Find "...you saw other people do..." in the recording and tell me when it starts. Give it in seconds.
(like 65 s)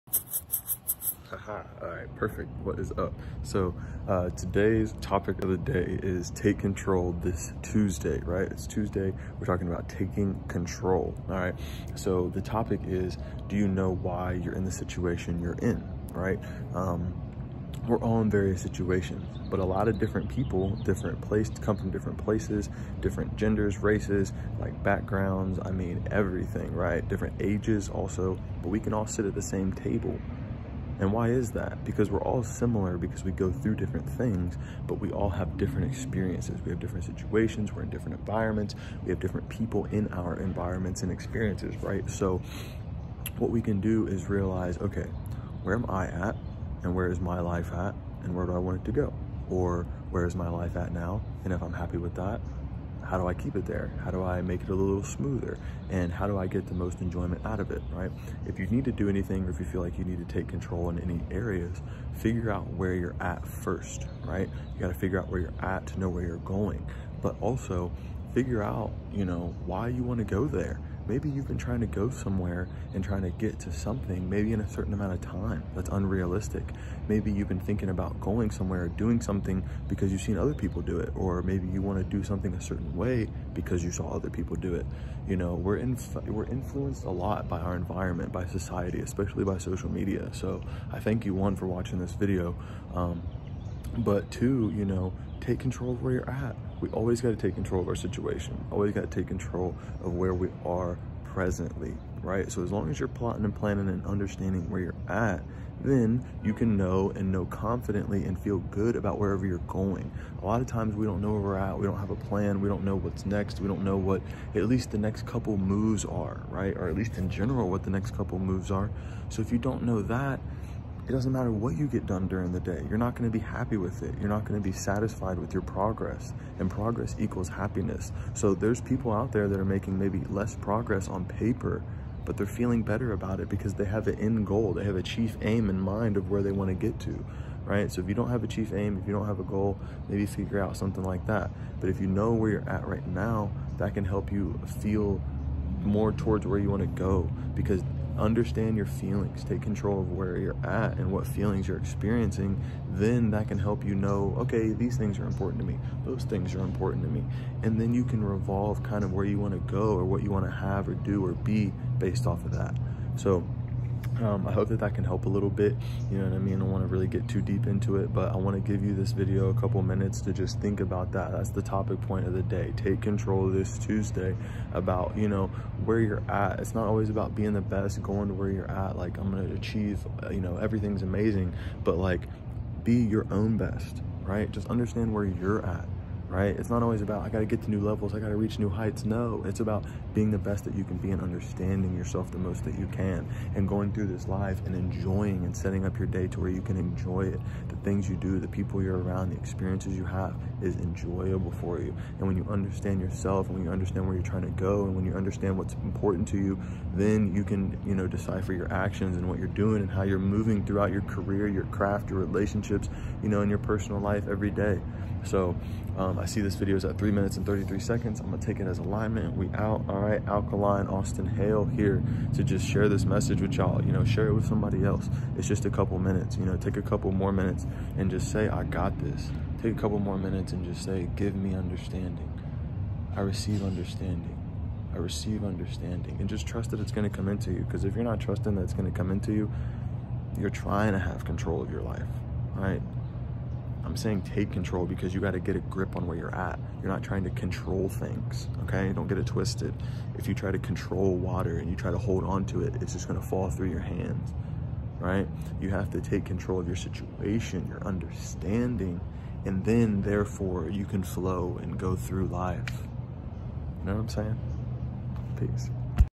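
83 s.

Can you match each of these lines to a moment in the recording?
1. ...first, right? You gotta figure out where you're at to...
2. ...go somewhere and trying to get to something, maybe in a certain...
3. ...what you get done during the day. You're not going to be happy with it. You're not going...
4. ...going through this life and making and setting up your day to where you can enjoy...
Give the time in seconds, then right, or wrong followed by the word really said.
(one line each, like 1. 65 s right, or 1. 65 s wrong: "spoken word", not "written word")
1. 63 s right
2. 71 s right
3. 121 s right
4. 193 s wrong: "enjoying", not "making".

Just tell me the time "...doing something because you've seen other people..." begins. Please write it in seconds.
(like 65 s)
78 s.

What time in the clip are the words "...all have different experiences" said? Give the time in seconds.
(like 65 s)
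35 s.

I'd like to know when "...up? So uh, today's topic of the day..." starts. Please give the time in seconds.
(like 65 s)
2 s.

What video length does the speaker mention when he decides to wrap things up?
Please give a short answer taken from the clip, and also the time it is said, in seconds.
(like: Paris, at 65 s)
3 minutes 33 seconds, at 216 s.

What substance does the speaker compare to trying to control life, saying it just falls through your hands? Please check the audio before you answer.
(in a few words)
Water.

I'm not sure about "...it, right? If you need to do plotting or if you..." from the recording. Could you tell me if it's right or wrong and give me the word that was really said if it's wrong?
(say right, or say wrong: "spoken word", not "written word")
wrong: "anything", not "plotting".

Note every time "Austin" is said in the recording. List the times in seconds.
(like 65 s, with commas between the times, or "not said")
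220 s.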